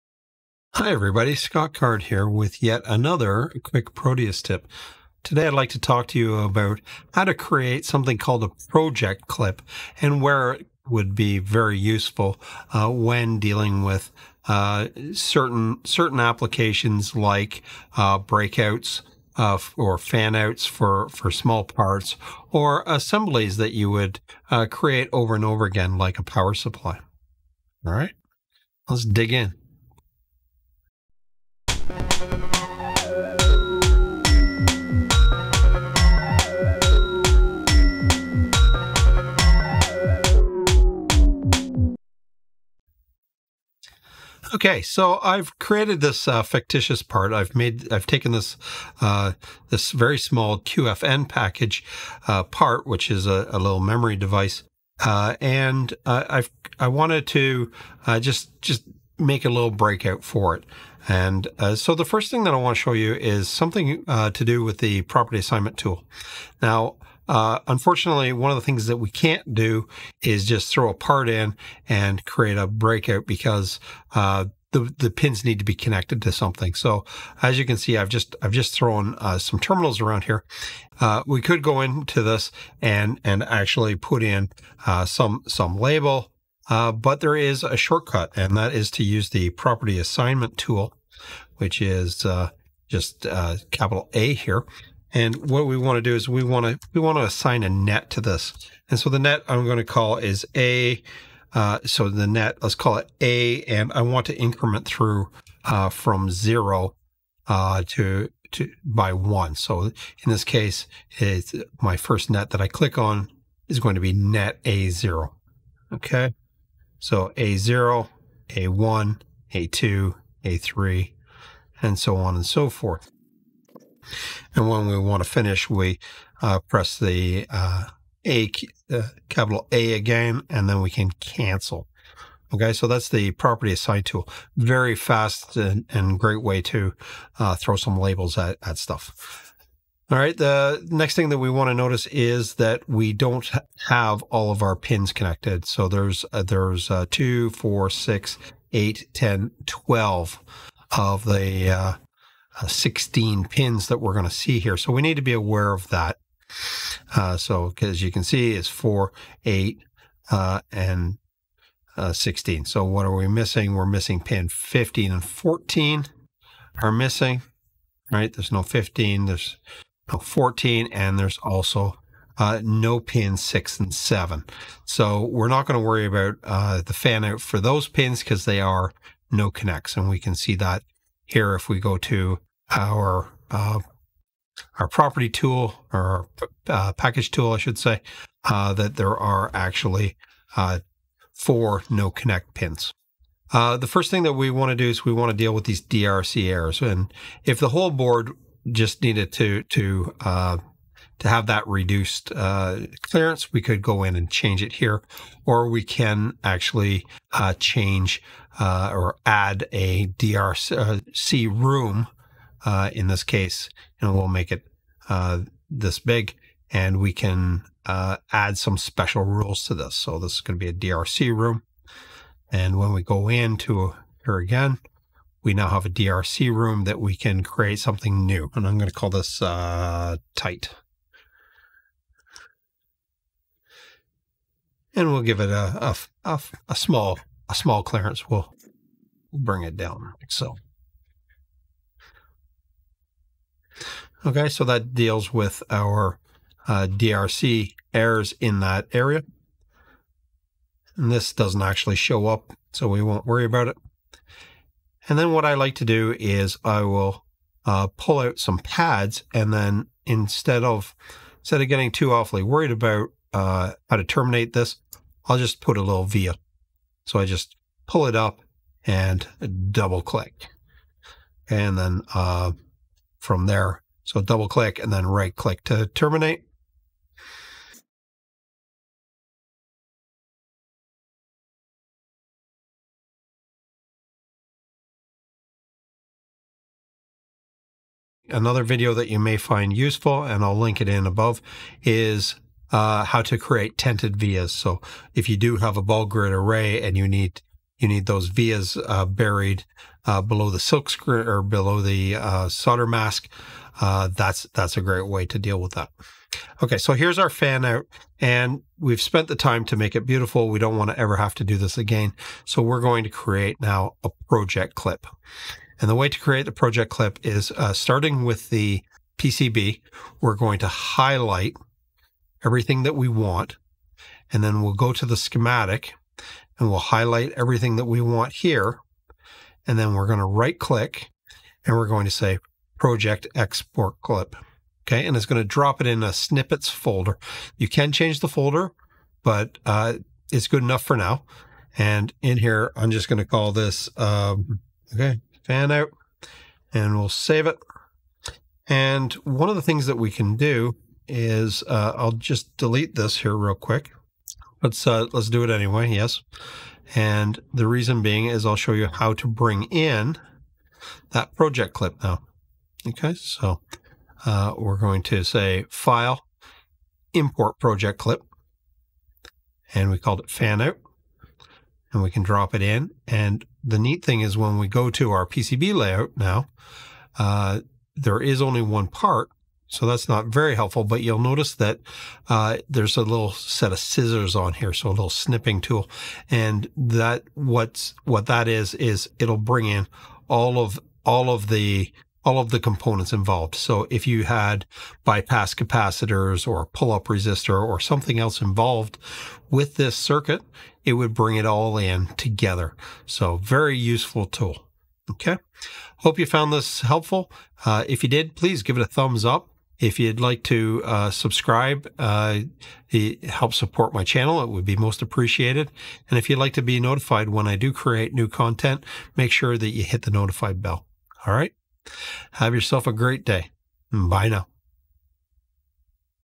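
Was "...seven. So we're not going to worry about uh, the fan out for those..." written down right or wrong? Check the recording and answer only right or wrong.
right.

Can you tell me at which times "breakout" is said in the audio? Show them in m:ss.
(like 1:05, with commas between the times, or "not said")
0:18, 0:59, 1:12.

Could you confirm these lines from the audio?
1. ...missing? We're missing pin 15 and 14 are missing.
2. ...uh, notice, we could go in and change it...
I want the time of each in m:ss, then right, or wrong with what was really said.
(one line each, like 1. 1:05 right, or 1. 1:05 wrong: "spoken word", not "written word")
1. 2:43 right
2. 3:22 wrong: "clearance", not "notice".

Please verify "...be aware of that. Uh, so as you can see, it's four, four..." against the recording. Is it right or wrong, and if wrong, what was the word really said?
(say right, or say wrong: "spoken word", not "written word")
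wrong: "eight", not "four".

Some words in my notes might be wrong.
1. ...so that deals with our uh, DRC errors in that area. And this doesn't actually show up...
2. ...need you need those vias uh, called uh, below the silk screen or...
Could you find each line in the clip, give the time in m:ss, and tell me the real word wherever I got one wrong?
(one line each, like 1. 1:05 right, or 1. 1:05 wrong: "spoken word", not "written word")
1. 4:04 right
2. 4:57 wrong: "buried", not "called".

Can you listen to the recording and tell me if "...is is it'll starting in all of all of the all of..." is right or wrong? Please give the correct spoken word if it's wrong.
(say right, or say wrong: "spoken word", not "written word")
wrong: "bring", not "starting".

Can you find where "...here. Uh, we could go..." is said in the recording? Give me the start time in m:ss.
1:20.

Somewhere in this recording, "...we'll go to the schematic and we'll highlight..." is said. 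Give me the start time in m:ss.
5:24.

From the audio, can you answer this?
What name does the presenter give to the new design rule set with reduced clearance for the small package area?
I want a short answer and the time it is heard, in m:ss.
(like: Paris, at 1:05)
tight, at 3:50.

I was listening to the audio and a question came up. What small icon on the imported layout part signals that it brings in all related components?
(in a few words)
scissors.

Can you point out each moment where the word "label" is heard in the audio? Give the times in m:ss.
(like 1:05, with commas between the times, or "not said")
1:25, 2:17.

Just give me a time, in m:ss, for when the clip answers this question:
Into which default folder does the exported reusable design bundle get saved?
5:36.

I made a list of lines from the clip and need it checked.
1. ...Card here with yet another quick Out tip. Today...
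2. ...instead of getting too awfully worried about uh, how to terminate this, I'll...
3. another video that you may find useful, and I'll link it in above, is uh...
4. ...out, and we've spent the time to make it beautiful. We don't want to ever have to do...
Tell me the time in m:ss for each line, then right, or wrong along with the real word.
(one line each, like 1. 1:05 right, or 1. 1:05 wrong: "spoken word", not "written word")
1. 0:01 wrong: "Proteus", not "Out"
2. 4:21 right
3. 4:48 right
4. 5:07 right.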